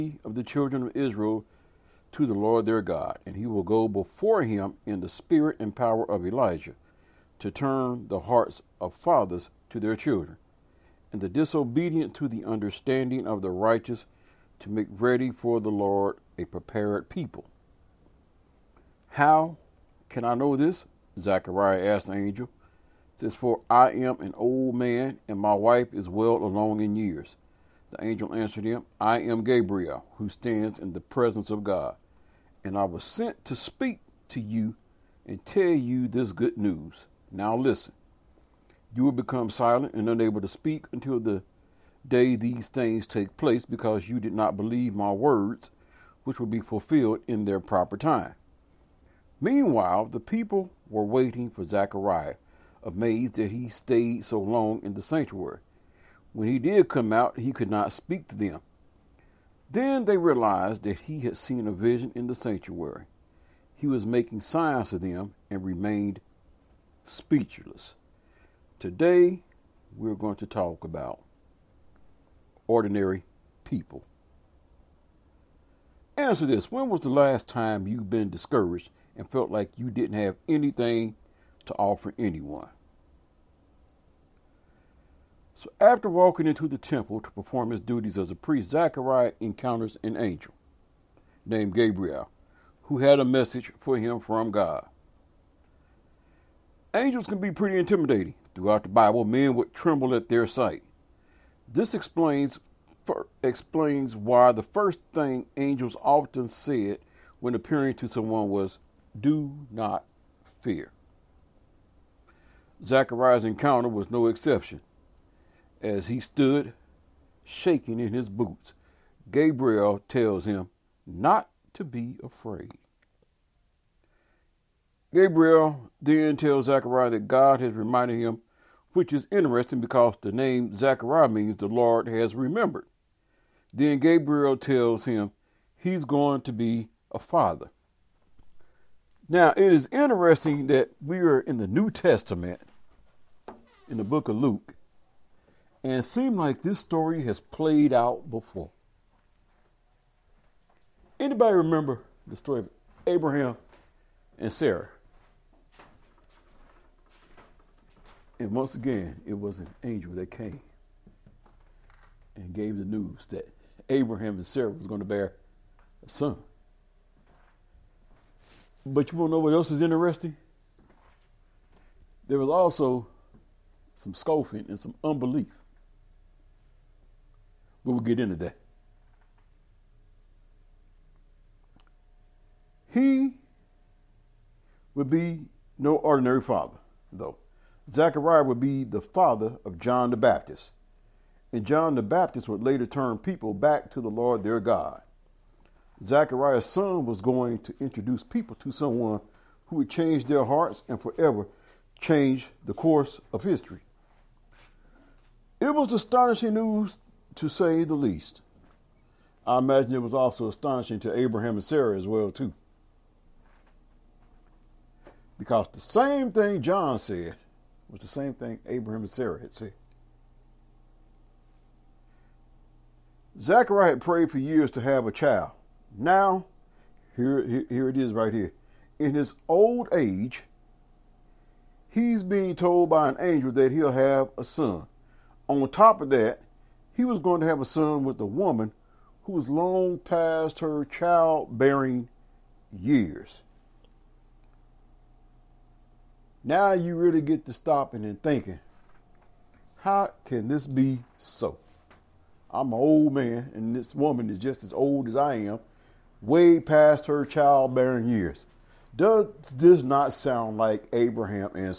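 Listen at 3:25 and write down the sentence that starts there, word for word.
It was astonishing news, to say the least.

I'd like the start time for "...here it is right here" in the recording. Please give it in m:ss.
3:47.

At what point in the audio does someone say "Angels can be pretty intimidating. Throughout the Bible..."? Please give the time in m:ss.
1:36.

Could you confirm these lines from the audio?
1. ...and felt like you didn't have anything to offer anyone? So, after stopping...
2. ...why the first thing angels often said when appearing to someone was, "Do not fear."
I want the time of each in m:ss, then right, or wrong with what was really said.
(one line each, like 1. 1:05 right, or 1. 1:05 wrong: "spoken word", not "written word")
1. 1:19 wrong: "walking", not "stopping"
2. 1:44 right.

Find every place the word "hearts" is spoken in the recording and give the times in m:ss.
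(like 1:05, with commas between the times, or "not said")
0:08, 3:20.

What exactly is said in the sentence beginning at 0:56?
When he did come out, he could not speak to them.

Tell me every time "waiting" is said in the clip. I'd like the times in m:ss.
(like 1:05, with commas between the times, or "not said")
0:51.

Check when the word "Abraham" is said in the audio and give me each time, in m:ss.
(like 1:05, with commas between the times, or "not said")
2:33, 2:43, 3:31, 3:38, 4:20.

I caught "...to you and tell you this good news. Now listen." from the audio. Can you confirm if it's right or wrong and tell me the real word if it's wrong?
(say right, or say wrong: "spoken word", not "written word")
right.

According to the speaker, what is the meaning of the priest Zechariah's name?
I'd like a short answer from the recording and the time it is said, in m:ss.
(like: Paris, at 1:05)
The Lord has remembered, at 2:11.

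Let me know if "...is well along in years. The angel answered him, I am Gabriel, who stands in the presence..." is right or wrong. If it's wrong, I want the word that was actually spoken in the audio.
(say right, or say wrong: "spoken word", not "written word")
right.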